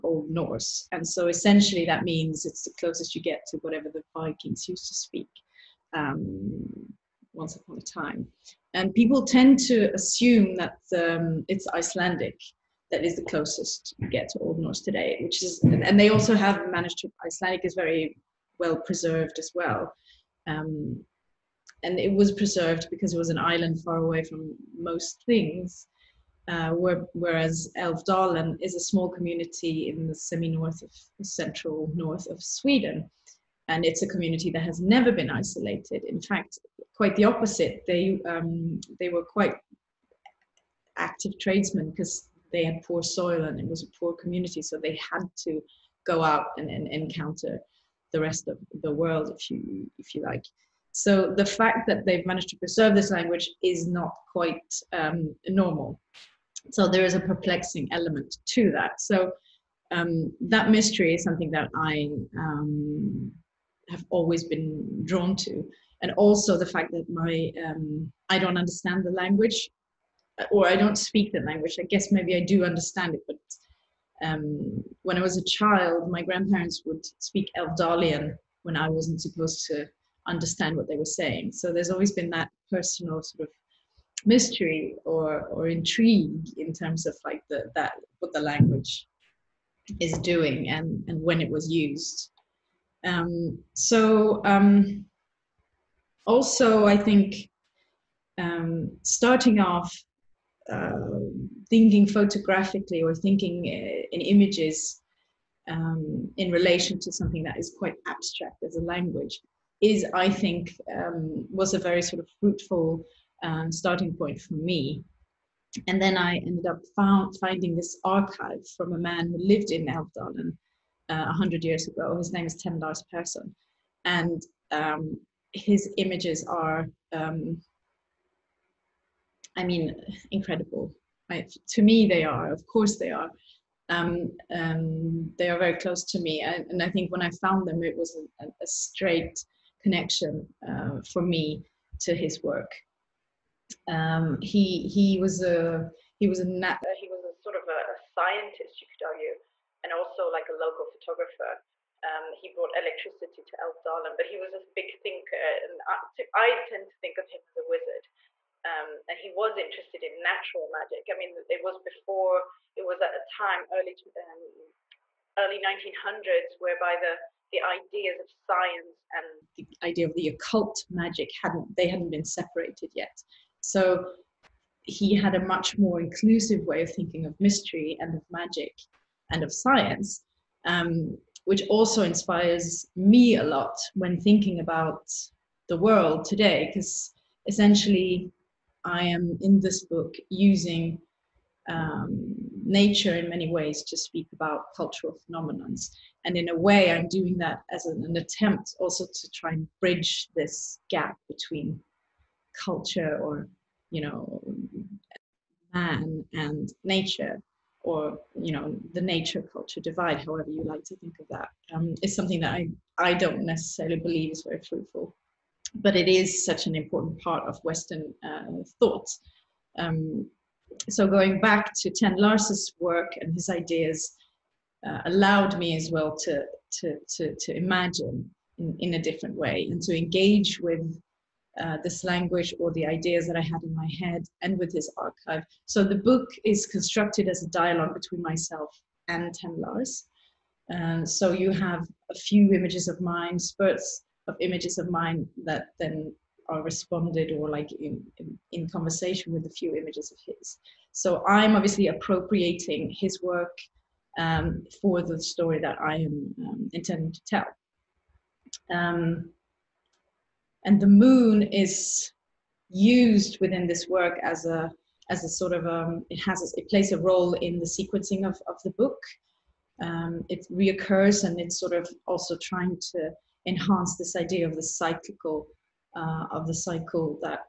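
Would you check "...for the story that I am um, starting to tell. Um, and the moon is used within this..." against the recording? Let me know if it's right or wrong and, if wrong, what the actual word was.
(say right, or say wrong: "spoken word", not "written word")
wrong: "intending", not "starting".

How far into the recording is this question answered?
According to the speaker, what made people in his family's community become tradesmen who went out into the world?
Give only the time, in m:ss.
0:42.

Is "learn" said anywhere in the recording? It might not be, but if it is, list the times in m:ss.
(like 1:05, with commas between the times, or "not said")
not said.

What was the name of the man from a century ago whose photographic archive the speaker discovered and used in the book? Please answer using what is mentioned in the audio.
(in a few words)
Tenn Lars Persson.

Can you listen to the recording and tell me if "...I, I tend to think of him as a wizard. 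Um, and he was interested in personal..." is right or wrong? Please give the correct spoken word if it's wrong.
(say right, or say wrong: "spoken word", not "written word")
wrong: "natural", not "personal".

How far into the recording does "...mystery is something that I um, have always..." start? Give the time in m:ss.
1:00.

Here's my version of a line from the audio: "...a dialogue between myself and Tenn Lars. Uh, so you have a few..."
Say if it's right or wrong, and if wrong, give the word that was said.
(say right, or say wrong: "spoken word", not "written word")
right.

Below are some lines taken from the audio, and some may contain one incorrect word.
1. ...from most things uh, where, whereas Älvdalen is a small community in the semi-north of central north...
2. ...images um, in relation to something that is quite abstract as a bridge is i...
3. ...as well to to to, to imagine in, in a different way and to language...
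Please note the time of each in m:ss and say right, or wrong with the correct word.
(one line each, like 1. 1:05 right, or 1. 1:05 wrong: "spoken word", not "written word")
1. 0:24 right
2. 1:44 wrong: "language", not "bridge"
3. 3:45 wrong: "engage", not "language".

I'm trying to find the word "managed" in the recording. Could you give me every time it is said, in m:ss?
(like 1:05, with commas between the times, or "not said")
0:16, 0:52.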